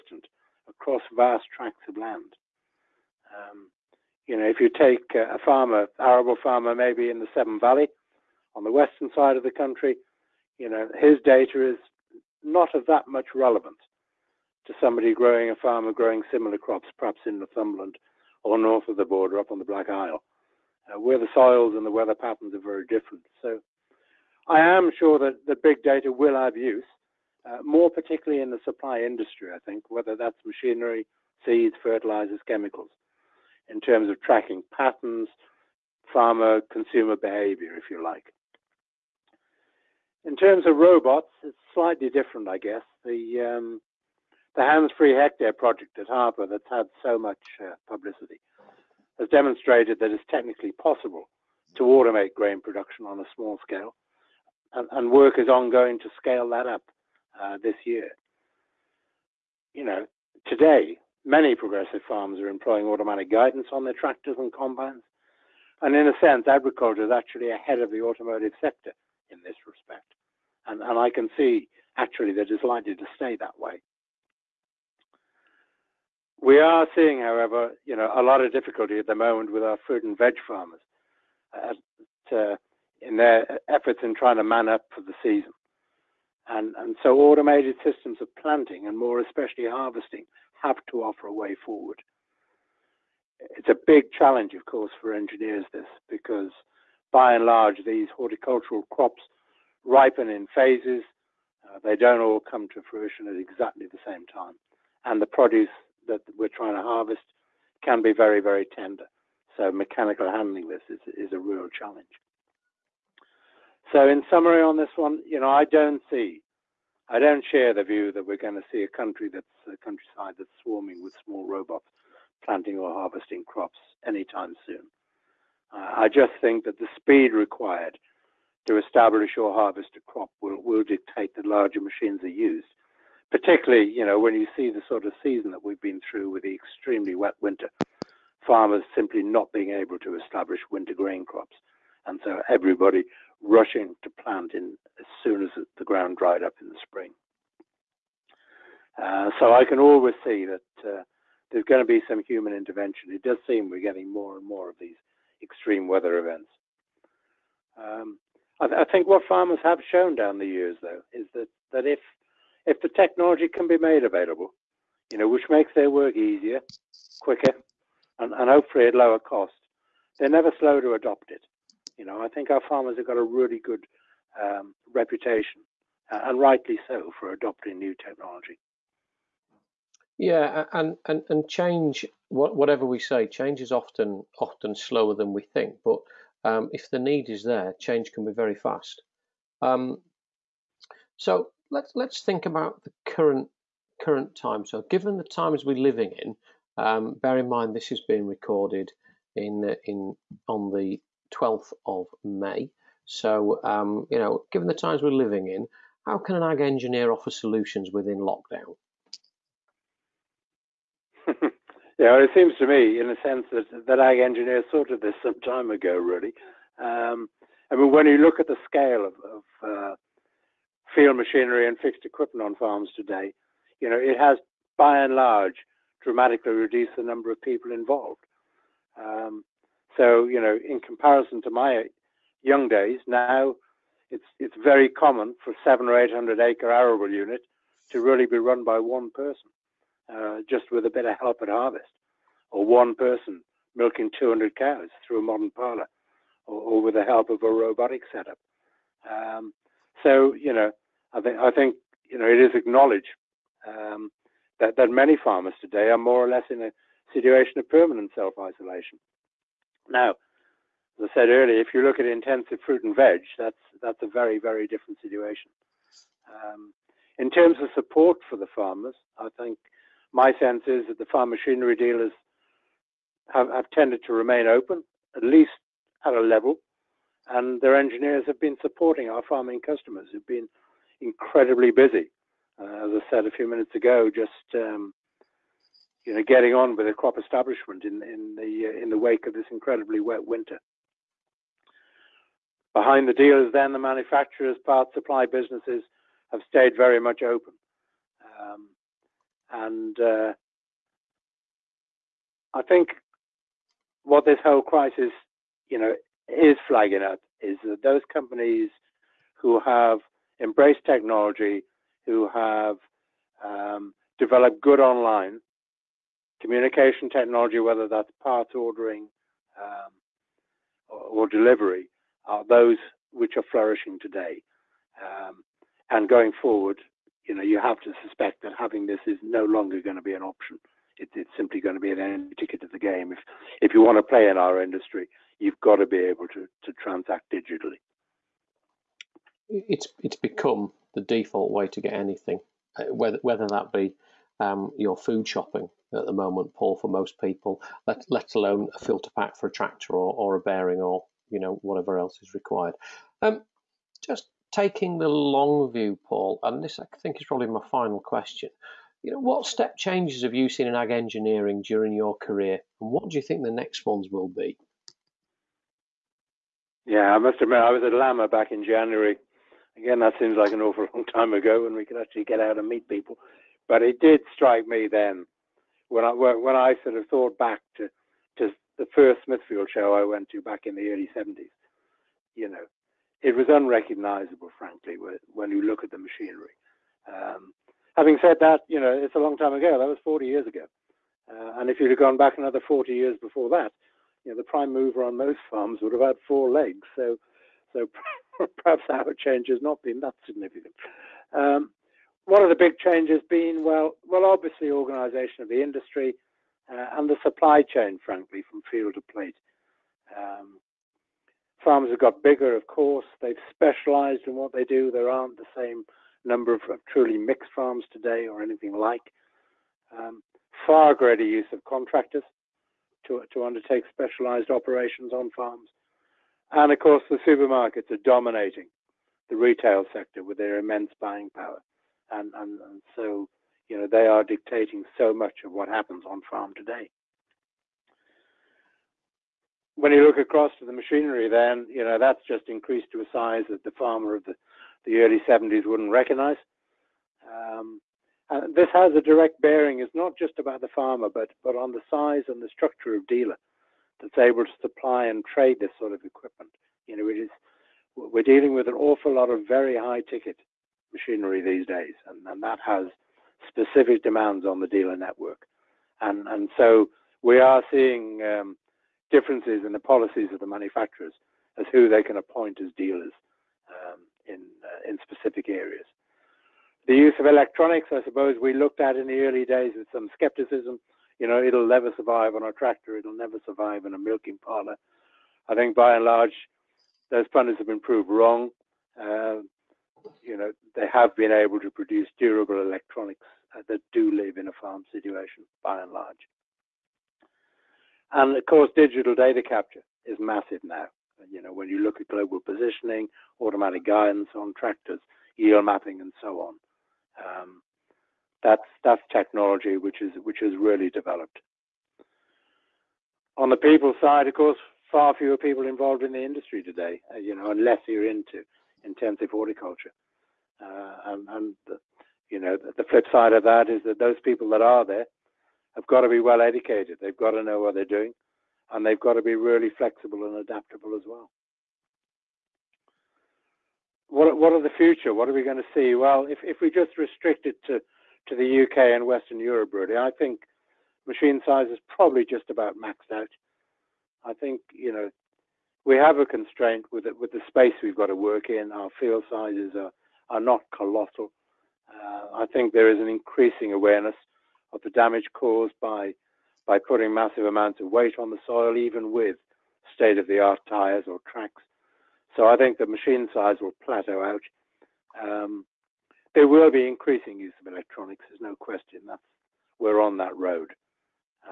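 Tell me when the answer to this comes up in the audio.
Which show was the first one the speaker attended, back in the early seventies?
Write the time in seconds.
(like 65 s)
379 s.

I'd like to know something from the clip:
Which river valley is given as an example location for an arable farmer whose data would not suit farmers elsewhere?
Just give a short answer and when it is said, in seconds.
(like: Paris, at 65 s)
Severn Valley, at 7 s.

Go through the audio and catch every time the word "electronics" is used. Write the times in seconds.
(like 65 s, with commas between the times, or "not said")
477 s, 492 s, 567 s.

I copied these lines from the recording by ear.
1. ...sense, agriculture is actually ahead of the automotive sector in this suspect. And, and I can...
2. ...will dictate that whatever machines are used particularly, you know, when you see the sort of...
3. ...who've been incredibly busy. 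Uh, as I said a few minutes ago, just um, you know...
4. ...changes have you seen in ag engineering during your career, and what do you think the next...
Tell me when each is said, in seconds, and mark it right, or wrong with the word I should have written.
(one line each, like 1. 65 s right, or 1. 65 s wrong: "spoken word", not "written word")
1. 66 s wrong: "respect", not "suspect"
2. 130 s wrong: "larger", not "whatever"
3. 280 s right
4. 359 s right.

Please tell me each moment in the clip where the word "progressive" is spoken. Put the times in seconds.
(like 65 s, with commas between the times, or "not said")
61 s.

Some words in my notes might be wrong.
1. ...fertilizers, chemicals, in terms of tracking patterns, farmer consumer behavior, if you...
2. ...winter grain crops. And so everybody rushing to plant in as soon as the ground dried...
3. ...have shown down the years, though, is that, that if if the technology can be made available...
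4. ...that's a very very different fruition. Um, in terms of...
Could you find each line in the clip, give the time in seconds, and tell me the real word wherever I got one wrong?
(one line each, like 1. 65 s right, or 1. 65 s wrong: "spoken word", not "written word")
1. 31 s right
2. 140 s right
3. 159 s right
4. 263 s wrong: "situation", not "fruition".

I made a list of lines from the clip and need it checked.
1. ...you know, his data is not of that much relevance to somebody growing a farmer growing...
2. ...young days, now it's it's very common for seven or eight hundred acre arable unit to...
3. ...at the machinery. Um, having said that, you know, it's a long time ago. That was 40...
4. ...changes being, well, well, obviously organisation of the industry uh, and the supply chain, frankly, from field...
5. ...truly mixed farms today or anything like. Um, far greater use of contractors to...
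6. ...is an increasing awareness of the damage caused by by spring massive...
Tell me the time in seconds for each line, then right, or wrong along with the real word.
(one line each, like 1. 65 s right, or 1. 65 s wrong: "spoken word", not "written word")
1. 10 s right
2. 232 s right
3. 385 s right
4. 402 s right
5. 416 s right
6. 552 s wrong: "putting", not "spring".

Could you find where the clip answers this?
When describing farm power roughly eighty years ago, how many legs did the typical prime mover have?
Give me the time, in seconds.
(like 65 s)
396 s.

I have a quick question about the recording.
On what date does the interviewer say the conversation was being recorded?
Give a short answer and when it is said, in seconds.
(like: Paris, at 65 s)
12th of May, at 201 s.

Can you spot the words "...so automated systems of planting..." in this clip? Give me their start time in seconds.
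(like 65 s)
87 s.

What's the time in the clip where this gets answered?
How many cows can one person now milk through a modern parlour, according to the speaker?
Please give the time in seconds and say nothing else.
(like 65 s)
244 s.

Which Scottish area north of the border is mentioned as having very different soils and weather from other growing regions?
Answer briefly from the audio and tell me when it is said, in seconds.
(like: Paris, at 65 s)
Black Isle, at 19 s.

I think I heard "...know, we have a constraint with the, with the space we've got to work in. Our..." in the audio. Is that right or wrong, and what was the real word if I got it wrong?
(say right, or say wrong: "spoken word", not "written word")
right.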